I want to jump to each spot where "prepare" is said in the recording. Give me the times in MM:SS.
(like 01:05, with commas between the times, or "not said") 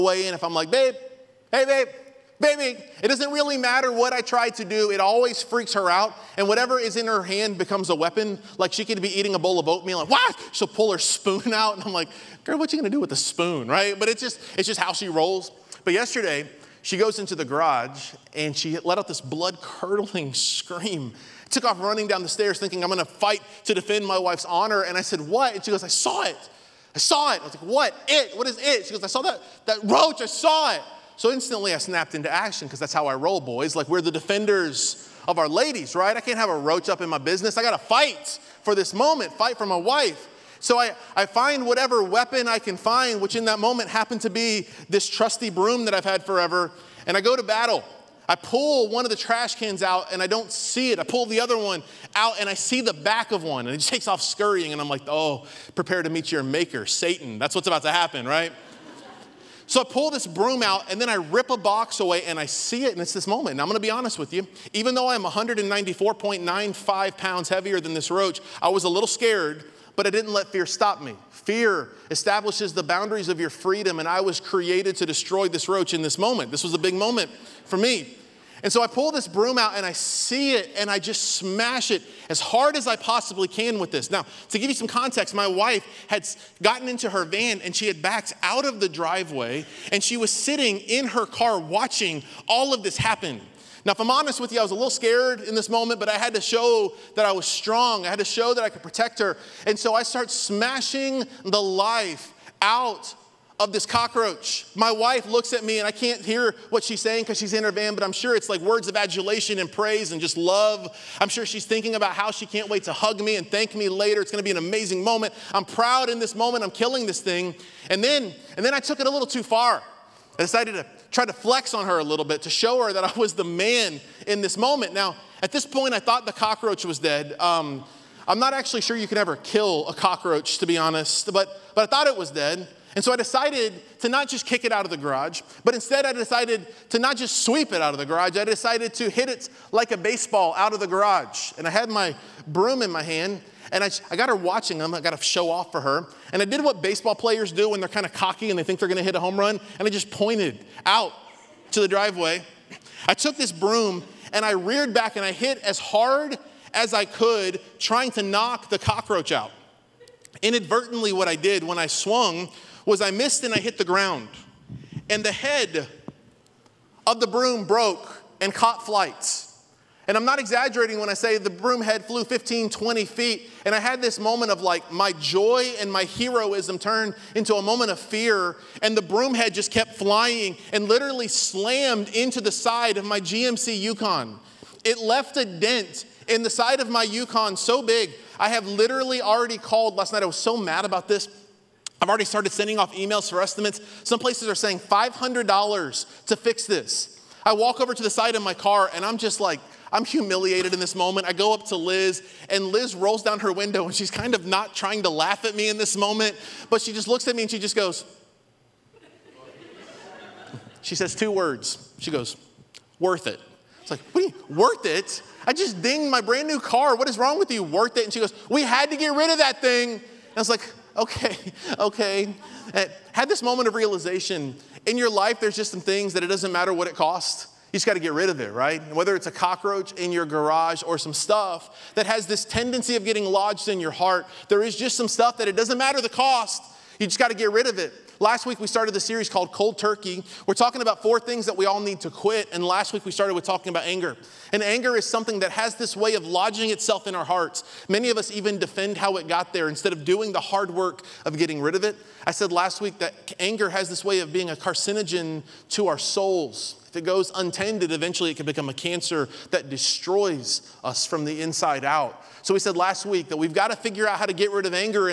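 00:55.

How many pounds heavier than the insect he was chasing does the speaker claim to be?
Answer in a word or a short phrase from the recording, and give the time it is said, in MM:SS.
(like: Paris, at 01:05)
194.95, at 01:05.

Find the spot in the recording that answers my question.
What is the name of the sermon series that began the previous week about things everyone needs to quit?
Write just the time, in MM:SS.
03:59.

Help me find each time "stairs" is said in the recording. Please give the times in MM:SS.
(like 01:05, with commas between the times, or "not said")
00:22.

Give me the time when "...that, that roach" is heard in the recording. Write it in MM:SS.
00:29.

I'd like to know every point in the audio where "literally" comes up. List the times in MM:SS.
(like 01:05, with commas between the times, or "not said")
03:00, 03:08.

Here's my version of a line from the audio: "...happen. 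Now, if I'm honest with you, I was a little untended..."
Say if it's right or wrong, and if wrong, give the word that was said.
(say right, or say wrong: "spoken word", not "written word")
wrong: "scared", not "untended".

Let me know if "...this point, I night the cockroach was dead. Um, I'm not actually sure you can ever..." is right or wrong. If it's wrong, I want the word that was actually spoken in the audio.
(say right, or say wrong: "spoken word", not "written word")
wrong: "thought", not "night".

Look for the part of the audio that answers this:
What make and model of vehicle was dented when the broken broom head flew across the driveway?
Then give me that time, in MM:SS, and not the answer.
03:03.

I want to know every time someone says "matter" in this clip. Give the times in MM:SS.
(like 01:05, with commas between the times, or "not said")
00:03, 03:46, 03:55.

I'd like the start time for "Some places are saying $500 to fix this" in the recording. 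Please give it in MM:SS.
03:14.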